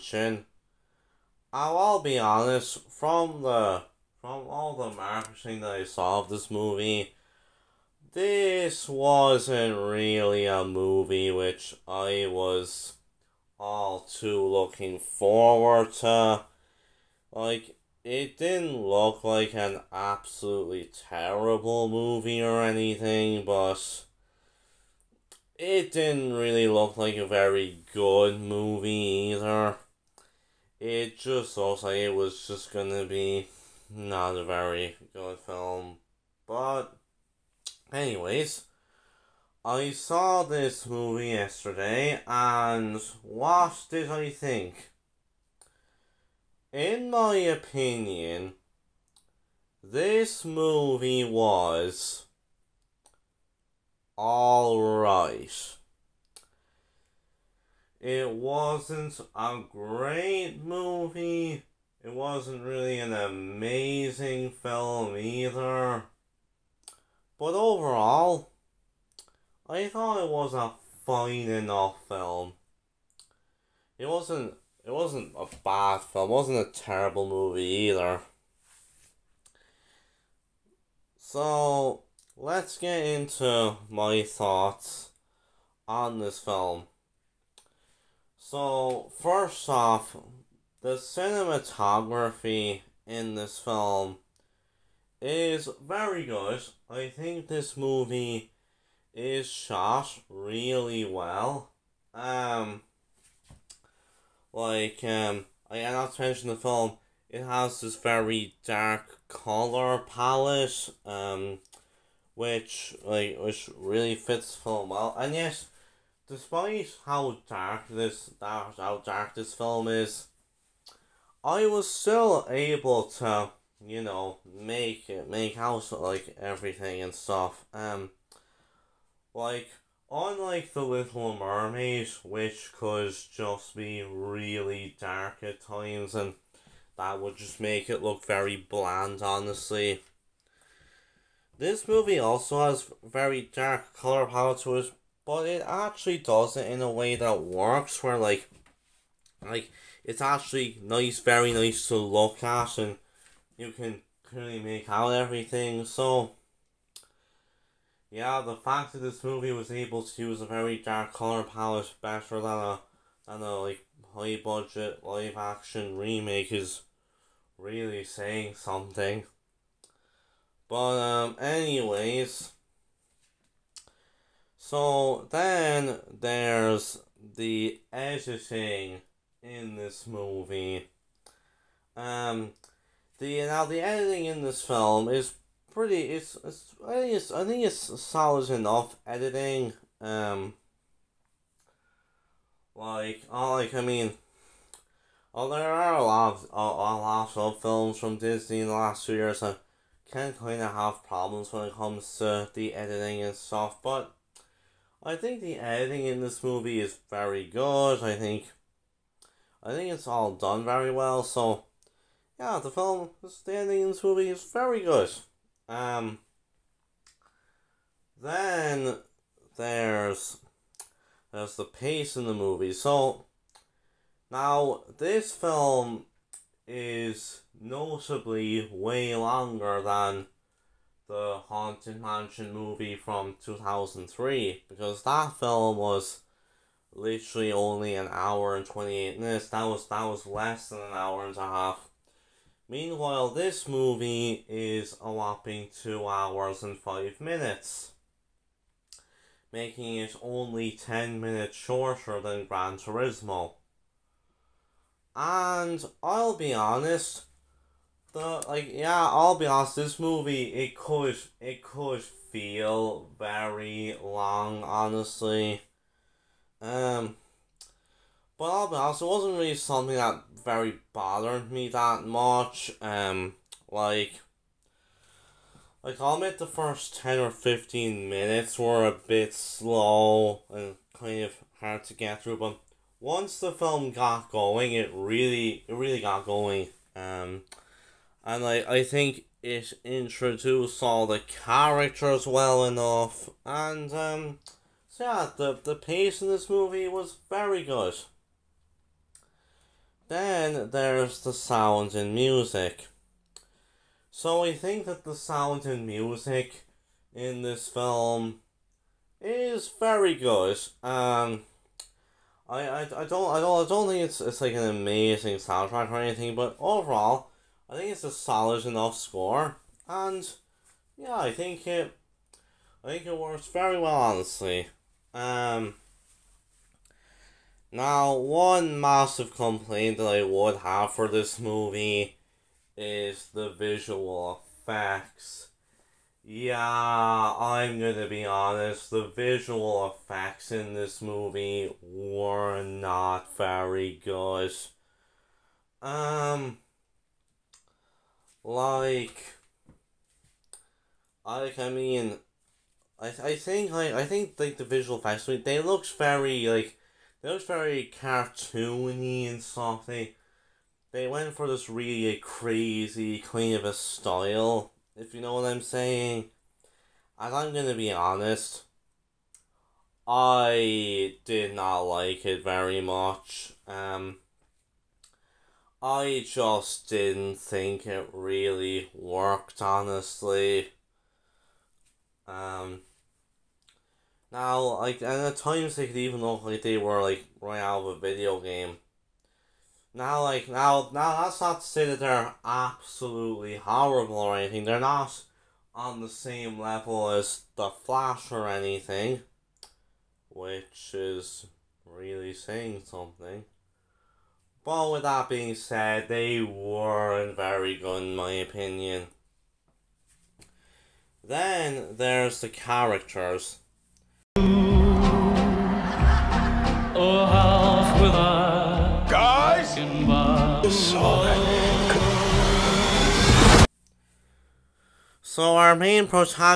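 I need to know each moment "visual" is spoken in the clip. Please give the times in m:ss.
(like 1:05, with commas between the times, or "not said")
5:33, 5:39, 5:54.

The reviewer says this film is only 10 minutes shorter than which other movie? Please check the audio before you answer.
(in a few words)
Gran Turismo.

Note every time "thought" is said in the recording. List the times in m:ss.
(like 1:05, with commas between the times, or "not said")
1:09, 1:24.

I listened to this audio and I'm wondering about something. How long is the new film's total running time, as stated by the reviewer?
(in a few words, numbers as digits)
2 hours 5 minutes.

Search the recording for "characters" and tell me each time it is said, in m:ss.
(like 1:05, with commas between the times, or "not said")
4:51, 6:52.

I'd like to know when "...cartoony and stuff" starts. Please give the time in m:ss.
5:58.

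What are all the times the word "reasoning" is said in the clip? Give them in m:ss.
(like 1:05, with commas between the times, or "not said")
not said.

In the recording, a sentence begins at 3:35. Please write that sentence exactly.
Um, then there's there's the pace in the movie.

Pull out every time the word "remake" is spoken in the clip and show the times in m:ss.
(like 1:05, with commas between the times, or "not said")
2:45.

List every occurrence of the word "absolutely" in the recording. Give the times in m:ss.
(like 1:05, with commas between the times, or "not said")
0:19, 6:32.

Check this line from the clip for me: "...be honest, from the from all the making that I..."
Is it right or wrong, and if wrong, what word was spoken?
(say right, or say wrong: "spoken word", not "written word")
wrong: "marketing", not "making".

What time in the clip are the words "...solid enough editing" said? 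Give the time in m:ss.
3:08.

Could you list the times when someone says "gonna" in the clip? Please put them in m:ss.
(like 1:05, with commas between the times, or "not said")
0:32, 5:37, 6:07.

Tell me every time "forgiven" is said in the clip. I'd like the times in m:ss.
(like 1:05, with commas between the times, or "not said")
not said.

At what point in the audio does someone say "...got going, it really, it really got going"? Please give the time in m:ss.
4:43.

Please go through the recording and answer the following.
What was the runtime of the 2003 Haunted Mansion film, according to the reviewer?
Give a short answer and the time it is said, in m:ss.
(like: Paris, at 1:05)
1 hour 28 minutes, at 3:57.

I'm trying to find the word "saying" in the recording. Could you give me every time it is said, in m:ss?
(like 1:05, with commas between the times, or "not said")
2:48, 6:05, 6:42.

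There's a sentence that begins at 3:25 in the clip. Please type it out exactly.
I think the editing in this movie is very good.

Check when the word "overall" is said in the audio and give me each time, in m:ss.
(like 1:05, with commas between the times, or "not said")
1:07, 5:16.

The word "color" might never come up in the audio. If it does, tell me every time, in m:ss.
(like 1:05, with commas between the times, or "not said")
1:49, 2:23, 2:41.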